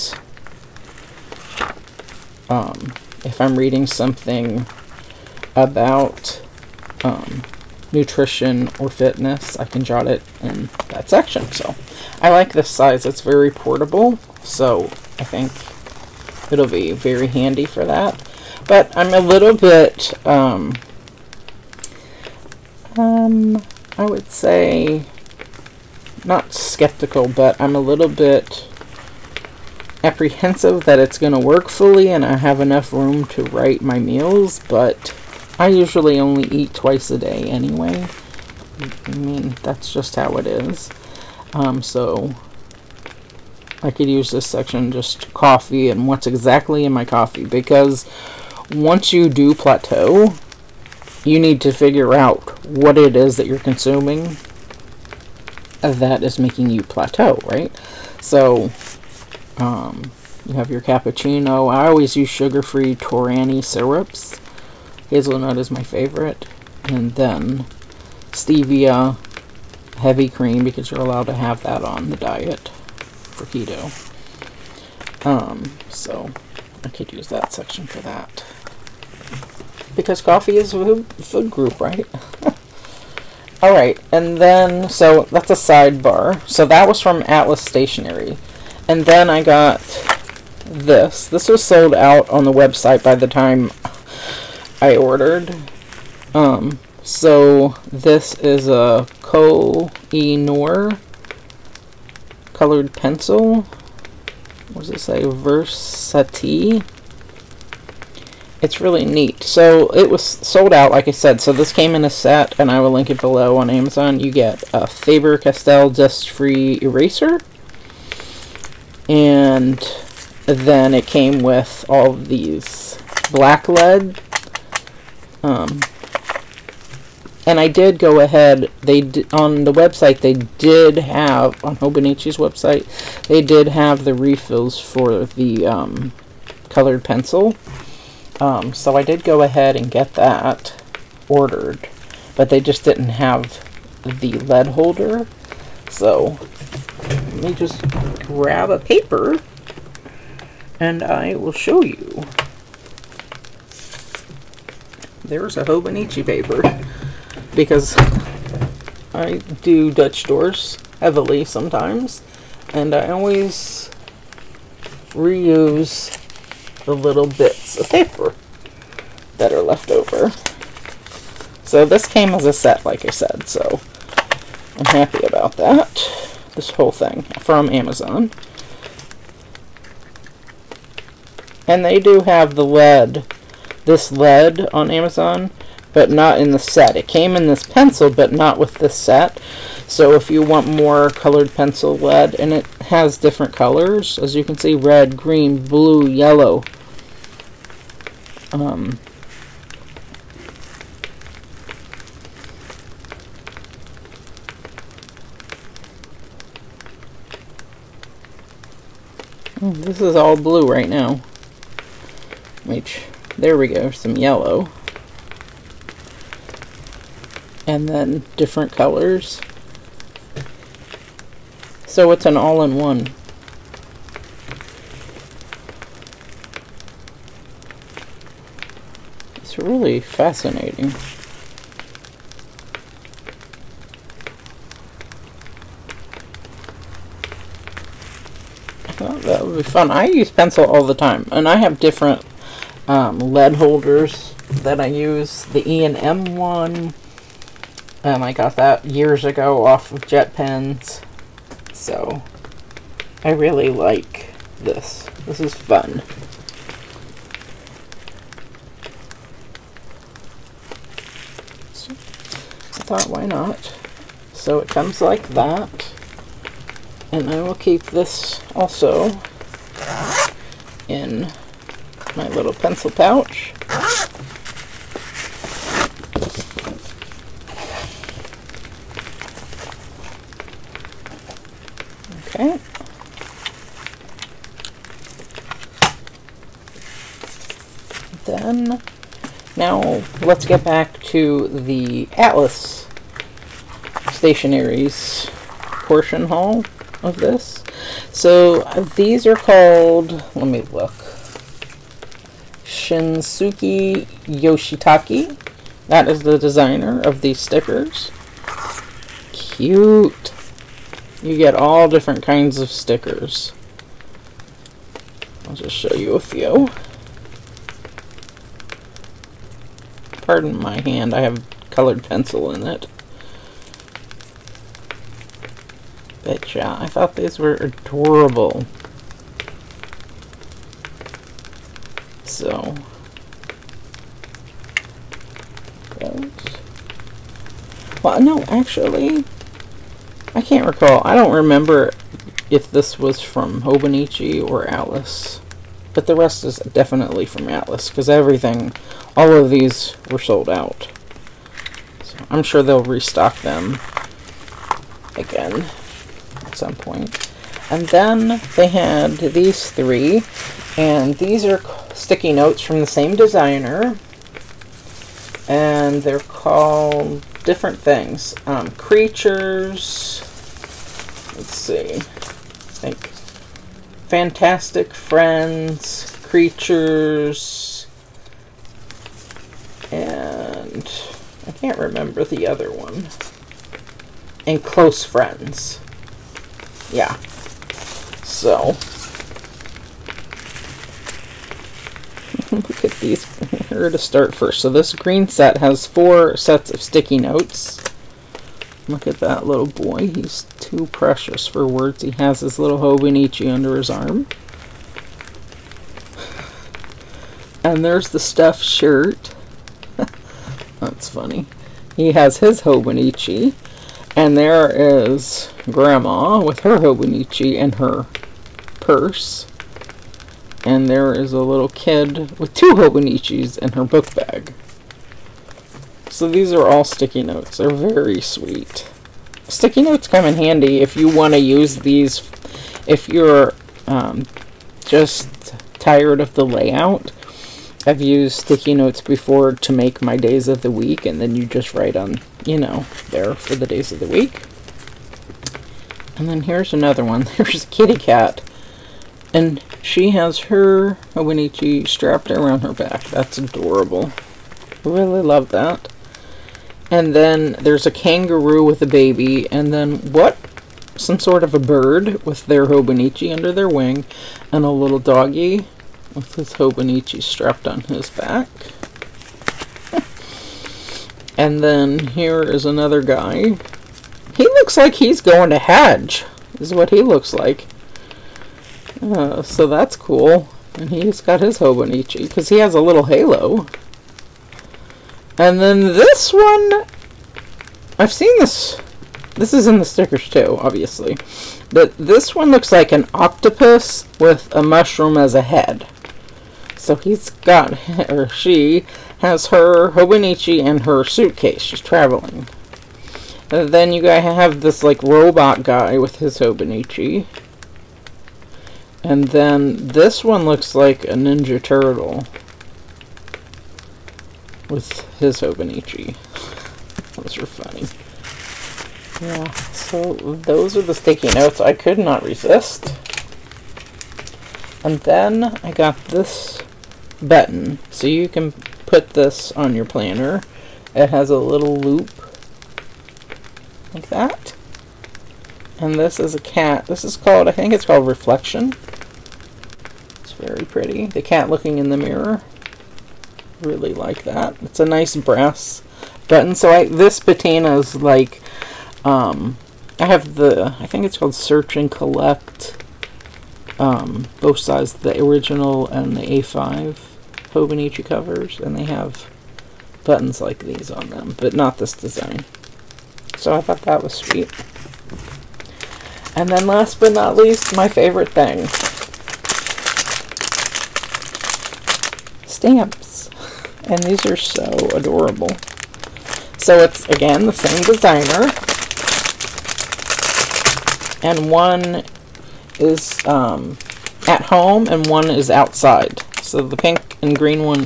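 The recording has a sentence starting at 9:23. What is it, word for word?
So I thought that was sweet.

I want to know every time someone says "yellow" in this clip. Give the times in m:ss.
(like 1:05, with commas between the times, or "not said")
3:16, 3:34.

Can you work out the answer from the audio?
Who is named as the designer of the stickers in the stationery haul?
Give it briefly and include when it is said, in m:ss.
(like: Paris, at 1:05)
Shinsuke Yoshitake, at 5:02.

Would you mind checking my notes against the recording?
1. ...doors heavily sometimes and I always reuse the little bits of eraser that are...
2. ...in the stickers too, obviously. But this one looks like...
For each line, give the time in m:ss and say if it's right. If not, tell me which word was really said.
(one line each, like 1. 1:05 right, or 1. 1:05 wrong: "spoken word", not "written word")
1. 2:40 wrong: "paper", not "eraser"
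2. 8:09 right.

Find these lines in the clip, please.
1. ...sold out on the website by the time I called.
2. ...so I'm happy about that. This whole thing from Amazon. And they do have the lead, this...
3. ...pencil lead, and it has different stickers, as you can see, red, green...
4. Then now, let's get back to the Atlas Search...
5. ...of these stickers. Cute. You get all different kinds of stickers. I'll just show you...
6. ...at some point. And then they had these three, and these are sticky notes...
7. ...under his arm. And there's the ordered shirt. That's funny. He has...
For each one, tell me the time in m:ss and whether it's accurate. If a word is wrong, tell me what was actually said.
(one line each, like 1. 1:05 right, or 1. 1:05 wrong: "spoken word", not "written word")
1. 1:31 wrong: "ordered", not "called"
2. 2:53 right
3. 3:11 wrong: "colors", not "stickers"
4. 4:48 wrong: "Stationers", not "Search"
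5. 5:07 right
6. 5:56 right
7. 6:43 wrong: "stuffed", not "ordered".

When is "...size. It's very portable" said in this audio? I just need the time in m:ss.
0:12.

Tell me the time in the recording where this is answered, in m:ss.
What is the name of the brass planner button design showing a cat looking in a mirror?
8:58.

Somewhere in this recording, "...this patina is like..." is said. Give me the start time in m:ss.
9:06.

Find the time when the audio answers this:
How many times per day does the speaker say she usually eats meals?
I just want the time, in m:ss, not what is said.
0:36.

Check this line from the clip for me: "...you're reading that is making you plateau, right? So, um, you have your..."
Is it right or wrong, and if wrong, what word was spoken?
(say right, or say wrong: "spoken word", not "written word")
wrong: "consuming", not "reading".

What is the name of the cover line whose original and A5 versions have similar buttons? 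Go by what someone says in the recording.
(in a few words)
Search and Collect.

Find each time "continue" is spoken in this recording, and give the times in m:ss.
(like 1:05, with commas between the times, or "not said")
not said.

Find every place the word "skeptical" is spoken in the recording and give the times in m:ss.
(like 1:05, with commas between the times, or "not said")
0:26.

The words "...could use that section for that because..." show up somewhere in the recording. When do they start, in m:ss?
1:16.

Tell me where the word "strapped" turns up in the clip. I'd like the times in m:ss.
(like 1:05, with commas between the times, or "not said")
7:31, 7:47.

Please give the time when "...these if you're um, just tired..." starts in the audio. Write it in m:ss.
7:11.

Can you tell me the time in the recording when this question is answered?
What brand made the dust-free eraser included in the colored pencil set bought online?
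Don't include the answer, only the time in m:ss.
1:54.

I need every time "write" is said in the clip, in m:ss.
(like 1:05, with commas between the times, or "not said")
0:33, 7:21.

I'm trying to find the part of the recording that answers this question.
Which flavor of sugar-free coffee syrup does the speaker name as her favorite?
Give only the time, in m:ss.
1:05.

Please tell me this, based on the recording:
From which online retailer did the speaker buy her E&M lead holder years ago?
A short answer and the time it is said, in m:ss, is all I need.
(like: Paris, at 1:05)
JetPens, at 4:10.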